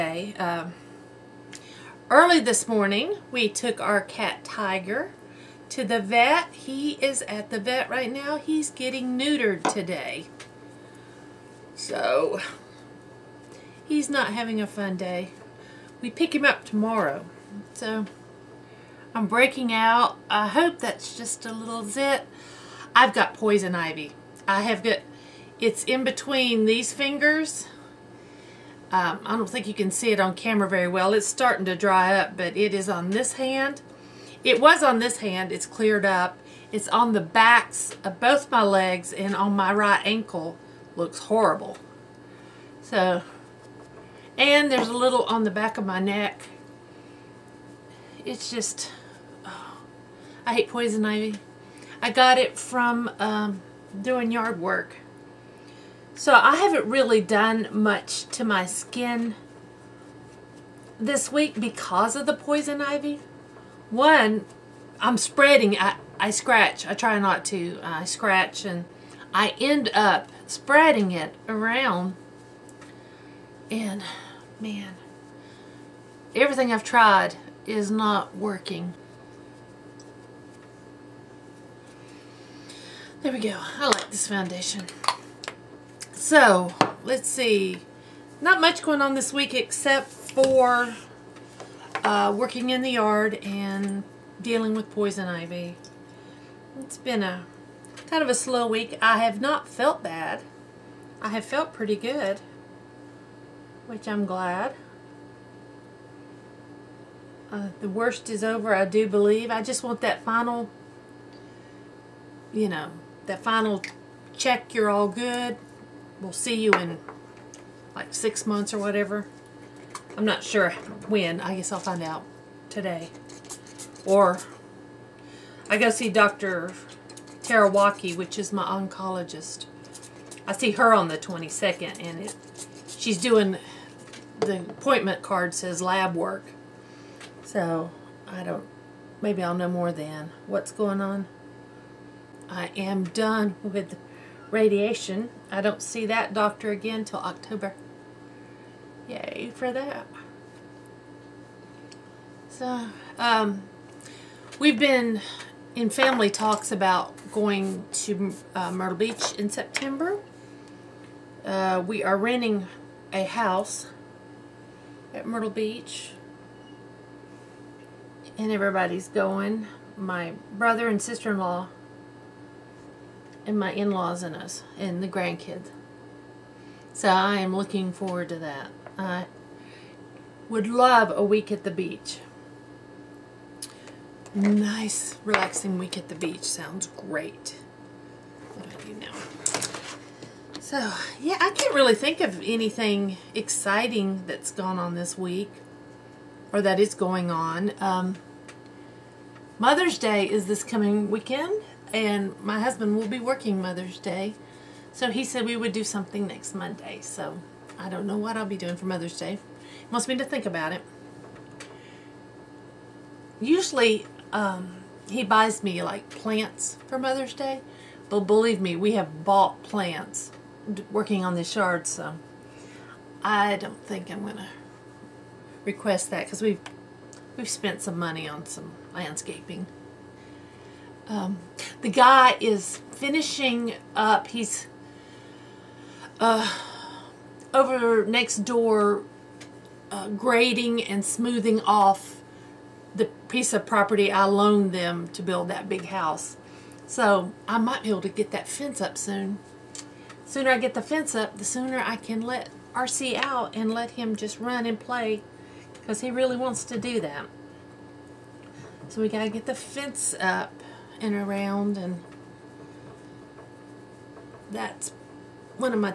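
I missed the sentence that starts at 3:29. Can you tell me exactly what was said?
He wants me to think about it.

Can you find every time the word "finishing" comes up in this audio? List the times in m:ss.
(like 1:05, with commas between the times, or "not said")
3:52.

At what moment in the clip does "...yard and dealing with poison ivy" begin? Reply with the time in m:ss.
1:32.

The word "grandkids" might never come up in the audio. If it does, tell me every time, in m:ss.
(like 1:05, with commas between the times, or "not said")
2:55.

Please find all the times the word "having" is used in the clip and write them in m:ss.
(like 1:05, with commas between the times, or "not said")
0:14.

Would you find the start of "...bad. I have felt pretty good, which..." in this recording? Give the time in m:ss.
1:40.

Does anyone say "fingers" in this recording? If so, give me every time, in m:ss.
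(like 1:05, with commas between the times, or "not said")
0:26.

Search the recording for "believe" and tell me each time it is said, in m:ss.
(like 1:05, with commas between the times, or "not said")
1:49, 3:38.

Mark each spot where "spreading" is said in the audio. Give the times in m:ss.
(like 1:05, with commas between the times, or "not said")
1:05, 1:10.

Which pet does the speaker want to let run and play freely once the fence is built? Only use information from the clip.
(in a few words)
RC.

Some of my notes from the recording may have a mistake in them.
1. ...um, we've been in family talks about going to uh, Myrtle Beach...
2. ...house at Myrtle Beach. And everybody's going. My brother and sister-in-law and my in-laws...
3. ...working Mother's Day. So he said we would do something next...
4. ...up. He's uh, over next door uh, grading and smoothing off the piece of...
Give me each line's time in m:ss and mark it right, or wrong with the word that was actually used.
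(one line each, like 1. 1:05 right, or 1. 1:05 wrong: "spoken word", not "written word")
1. 2:33 right
2. 2:43 right
3. 3:23 right
4. 3:53 right.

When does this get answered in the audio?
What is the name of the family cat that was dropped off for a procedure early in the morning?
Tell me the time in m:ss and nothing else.
0:04.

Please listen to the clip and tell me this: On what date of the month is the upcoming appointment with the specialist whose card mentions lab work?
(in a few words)
22nd.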